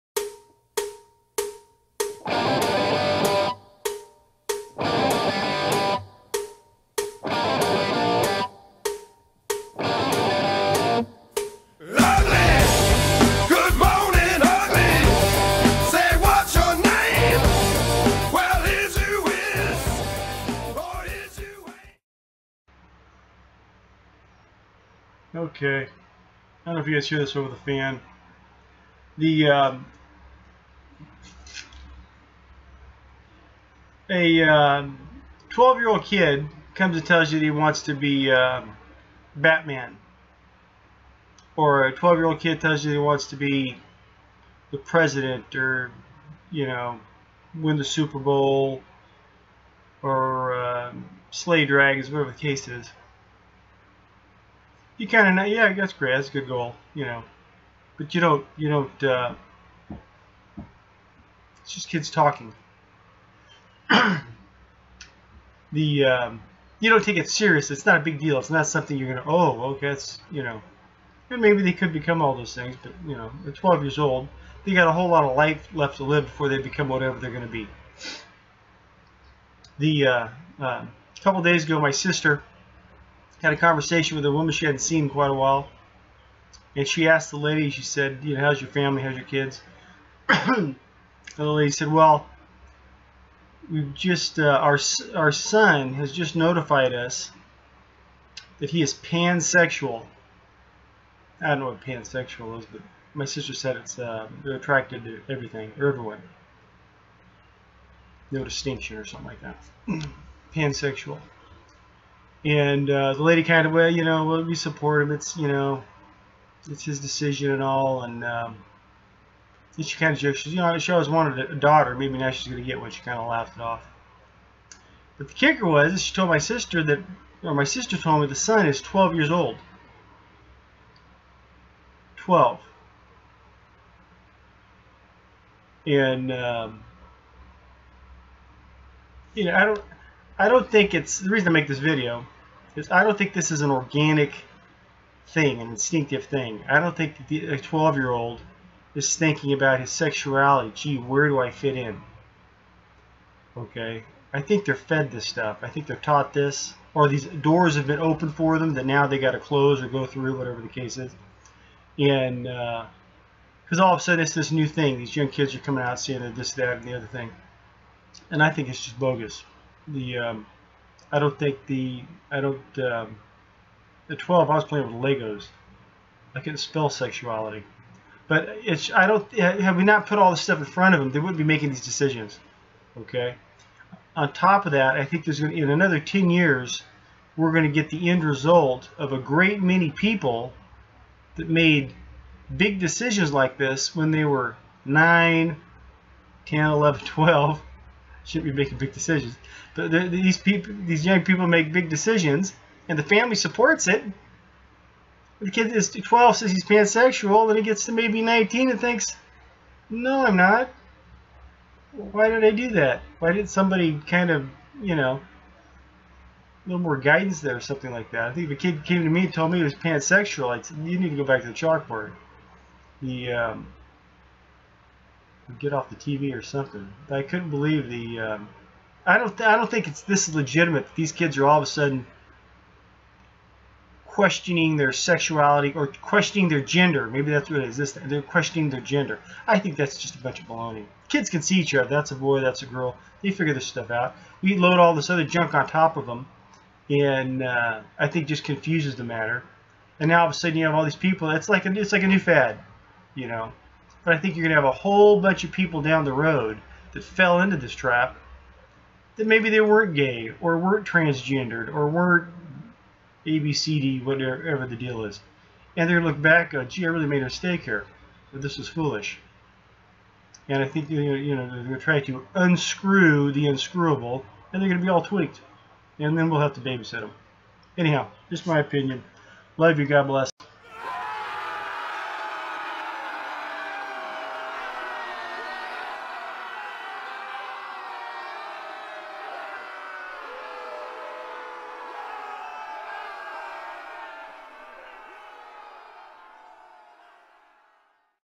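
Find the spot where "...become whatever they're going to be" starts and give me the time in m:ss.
1:16.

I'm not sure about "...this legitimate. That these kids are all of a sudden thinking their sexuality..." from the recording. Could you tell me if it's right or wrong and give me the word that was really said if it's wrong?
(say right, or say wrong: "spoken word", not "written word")
wrong: "questioning", not "thinking".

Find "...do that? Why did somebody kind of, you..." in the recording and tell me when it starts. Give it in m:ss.
3:32.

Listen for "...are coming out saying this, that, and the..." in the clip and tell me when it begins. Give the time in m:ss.
2:45.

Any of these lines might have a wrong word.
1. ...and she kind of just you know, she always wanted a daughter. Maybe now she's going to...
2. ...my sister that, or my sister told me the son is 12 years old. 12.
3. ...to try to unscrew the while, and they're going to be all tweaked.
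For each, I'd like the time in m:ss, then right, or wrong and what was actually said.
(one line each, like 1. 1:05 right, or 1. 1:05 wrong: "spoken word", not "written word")
1. 1:59 right
2. 2:06 right
3. 4:31 wrong: "unscrewable", not "while".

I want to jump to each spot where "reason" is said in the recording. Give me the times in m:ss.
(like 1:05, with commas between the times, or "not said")
2:21.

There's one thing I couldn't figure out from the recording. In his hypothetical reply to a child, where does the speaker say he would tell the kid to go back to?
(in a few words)
The chalkboard.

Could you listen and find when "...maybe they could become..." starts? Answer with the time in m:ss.
1:11.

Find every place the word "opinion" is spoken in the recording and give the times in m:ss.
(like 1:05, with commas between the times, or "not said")
4:38.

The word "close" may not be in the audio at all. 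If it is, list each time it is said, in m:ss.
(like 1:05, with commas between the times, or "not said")
2:39.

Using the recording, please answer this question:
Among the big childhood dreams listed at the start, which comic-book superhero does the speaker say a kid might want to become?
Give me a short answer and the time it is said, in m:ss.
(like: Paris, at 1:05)
Batman, at 0:39.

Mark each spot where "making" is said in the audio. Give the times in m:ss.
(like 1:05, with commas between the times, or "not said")
3:01, 3:18.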